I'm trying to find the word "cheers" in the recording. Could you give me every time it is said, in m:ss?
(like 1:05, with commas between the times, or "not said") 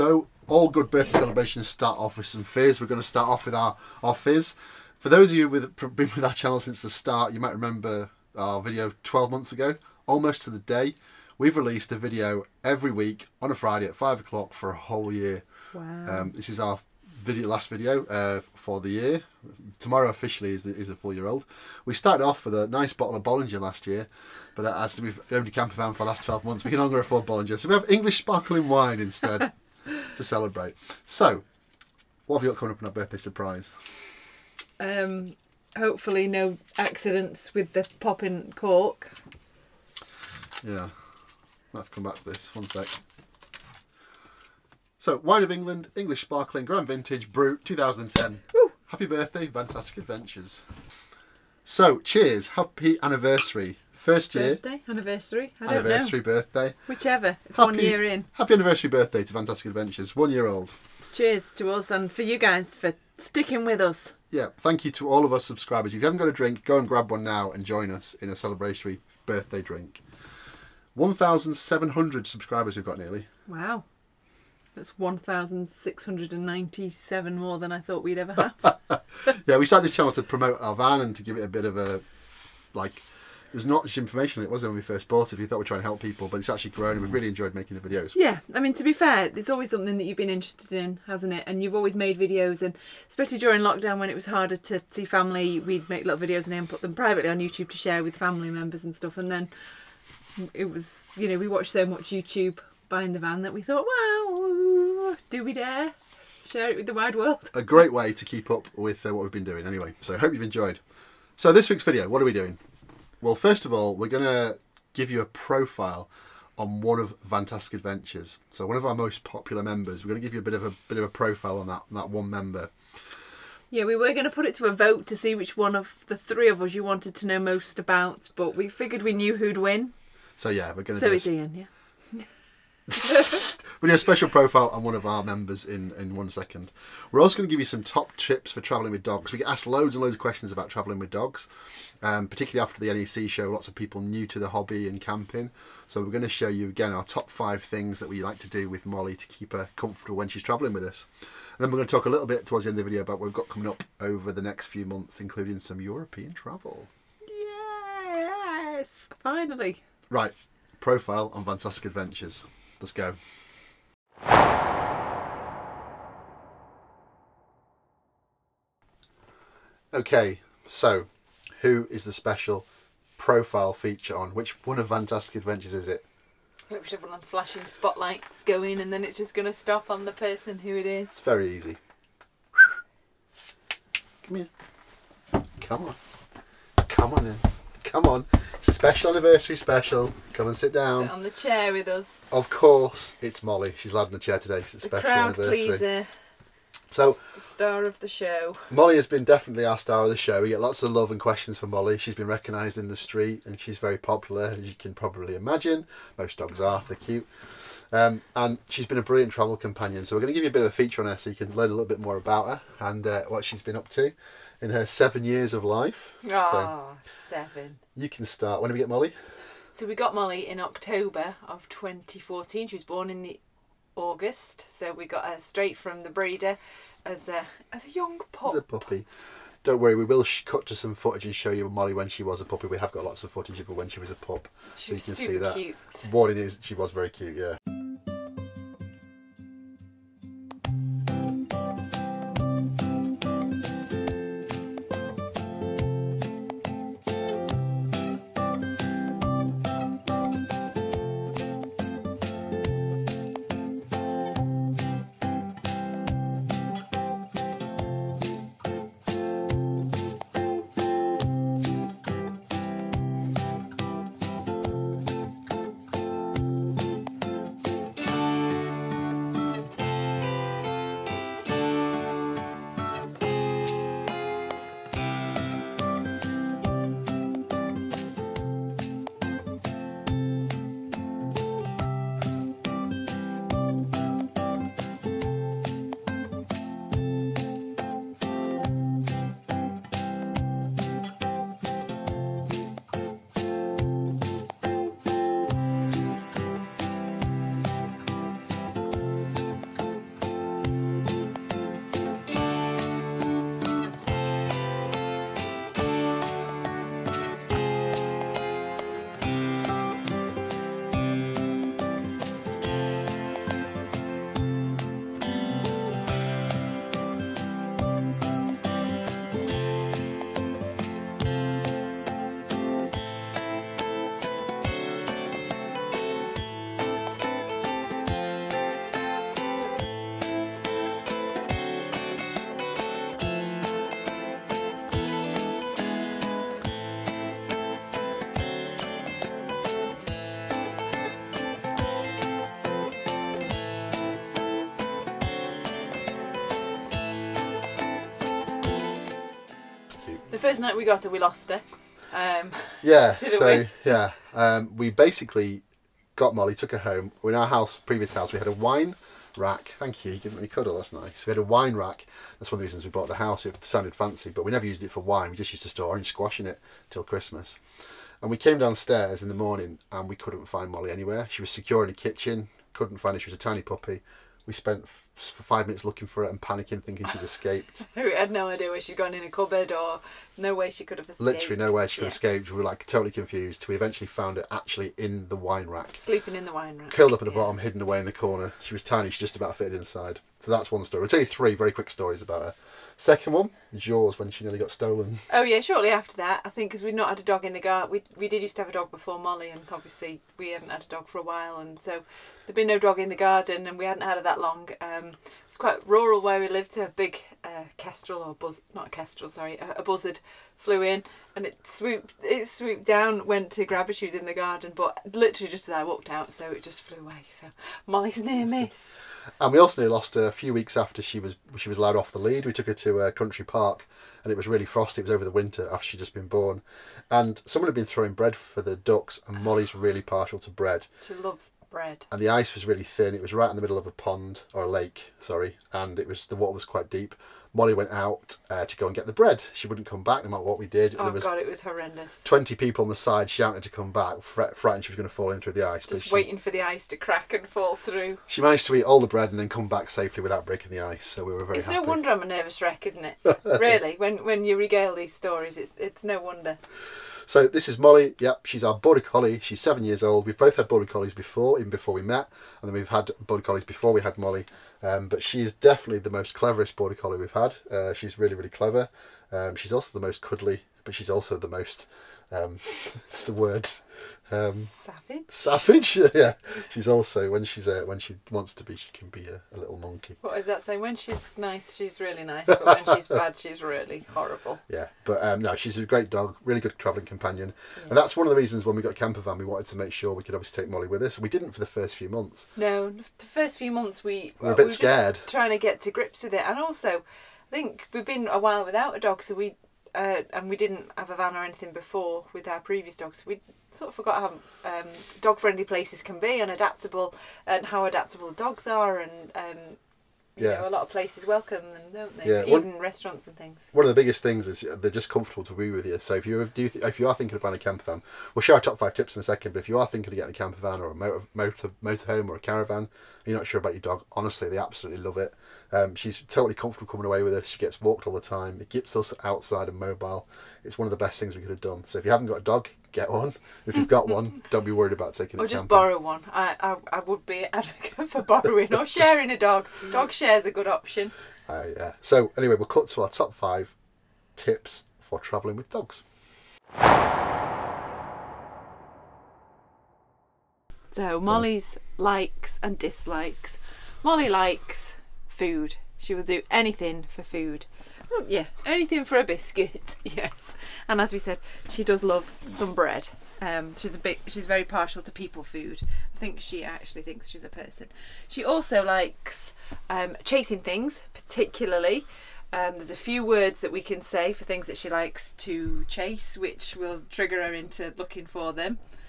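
0:51, 1:01.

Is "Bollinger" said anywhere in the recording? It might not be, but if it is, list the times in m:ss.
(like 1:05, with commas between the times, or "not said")
0:23, 0:27.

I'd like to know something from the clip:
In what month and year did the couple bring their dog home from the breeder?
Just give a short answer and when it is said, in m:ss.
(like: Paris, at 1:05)
October 2014, at 3:40.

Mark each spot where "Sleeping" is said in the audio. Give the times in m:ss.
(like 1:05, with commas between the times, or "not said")
6:25.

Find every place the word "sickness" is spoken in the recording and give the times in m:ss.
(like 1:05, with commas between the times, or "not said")
not said.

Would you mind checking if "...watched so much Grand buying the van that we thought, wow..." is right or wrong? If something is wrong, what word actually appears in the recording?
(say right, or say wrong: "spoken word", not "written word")
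wrong: "YouTube", not "Grand".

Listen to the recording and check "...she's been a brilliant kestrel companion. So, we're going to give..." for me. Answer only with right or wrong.
wrong.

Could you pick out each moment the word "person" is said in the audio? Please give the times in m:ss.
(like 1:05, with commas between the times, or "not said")
3:00, 9:27.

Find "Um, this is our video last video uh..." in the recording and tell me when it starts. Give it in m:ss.
0:16.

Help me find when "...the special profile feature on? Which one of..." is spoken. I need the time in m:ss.
2:52.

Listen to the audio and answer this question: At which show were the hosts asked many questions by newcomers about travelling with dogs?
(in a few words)
NEC.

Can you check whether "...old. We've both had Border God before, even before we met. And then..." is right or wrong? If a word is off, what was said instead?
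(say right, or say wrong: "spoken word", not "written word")
wrong: "Collies", not "God".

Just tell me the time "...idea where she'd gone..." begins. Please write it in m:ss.
6:18.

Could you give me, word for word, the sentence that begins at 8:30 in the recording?
know, a lot of places welcome them, don't they?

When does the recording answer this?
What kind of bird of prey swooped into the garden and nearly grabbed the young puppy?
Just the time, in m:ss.
6:49.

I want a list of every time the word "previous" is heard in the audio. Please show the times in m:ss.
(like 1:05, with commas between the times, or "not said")
5:57, 8:22.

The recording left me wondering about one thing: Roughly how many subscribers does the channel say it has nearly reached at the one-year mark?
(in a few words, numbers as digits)
1,700.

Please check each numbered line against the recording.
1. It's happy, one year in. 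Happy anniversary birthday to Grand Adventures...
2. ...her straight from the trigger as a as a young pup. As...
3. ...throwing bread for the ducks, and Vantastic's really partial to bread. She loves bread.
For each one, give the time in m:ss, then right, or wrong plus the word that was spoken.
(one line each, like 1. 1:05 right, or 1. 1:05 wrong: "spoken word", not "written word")
1. 0:57 wrong: "Vantastic", not "Grand"
2. 3:45 wrong: "breeder", not "trigger"
3. 7:07 wrong: "Mollie", not "Vantastic".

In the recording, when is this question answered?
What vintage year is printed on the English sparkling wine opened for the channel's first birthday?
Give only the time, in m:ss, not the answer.
0:47.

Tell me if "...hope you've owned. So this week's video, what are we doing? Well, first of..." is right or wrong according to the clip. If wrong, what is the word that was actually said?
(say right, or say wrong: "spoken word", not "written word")
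wrong: "enjoyed", not "owned".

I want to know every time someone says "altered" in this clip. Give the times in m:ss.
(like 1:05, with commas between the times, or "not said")
not said.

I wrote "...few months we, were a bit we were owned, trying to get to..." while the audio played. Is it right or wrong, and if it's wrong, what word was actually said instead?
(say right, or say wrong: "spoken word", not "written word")
wrong: "scared", not "owned".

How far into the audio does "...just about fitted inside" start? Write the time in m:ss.
6:29.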